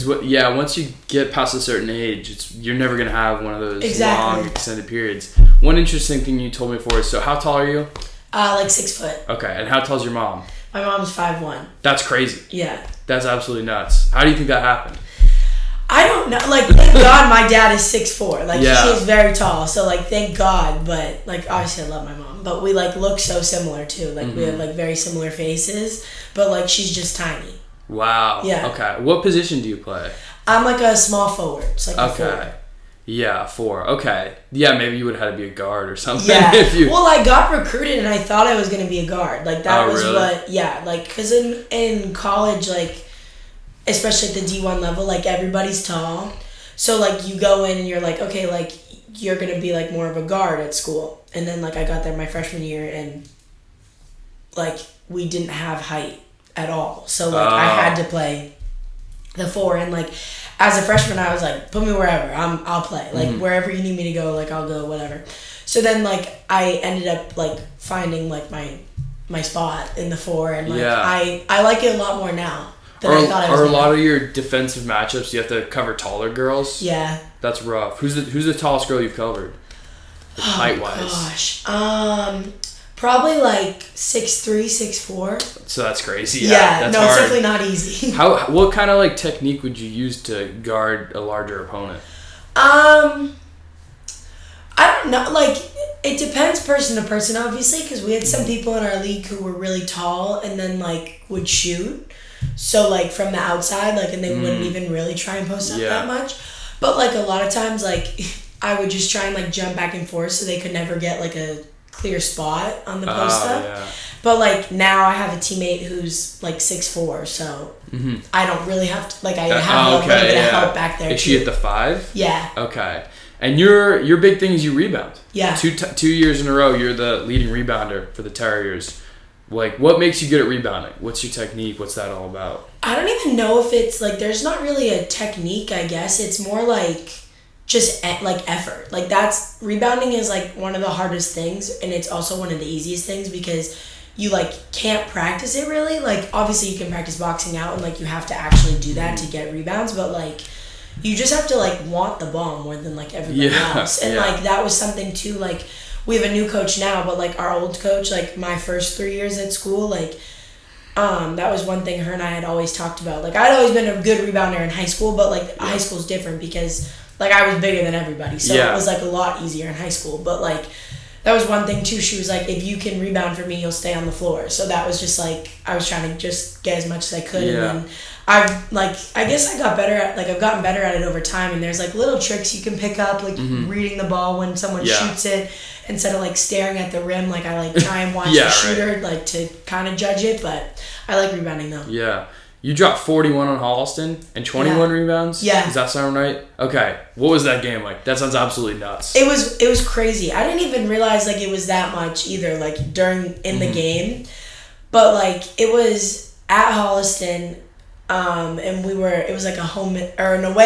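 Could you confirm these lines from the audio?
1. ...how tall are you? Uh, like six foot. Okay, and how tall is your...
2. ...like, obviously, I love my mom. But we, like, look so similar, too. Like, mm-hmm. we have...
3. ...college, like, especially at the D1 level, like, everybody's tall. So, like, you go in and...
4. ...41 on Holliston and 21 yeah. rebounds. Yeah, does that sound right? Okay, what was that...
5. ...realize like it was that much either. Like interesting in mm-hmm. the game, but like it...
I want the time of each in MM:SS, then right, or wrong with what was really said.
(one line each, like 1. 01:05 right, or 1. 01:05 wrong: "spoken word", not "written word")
1. 00:07 right
2. 00:21 right
3. 00:42 right
4. 03:12 right
5. 03:20 wrong: "during", not "interesting".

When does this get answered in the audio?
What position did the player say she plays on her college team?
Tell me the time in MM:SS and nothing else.
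00:30.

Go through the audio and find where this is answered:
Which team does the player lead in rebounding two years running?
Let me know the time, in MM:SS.
02:08.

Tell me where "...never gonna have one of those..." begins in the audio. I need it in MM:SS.
00:02.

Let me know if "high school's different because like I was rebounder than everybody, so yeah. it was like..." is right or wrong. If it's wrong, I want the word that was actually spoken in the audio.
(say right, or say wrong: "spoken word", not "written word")
wrong: "bigger", not "rebounder".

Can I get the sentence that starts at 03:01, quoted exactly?
And there's like little tricks you can pick up, like mm-hmm.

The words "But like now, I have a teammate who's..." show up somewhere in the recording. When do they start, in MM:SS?
01:54.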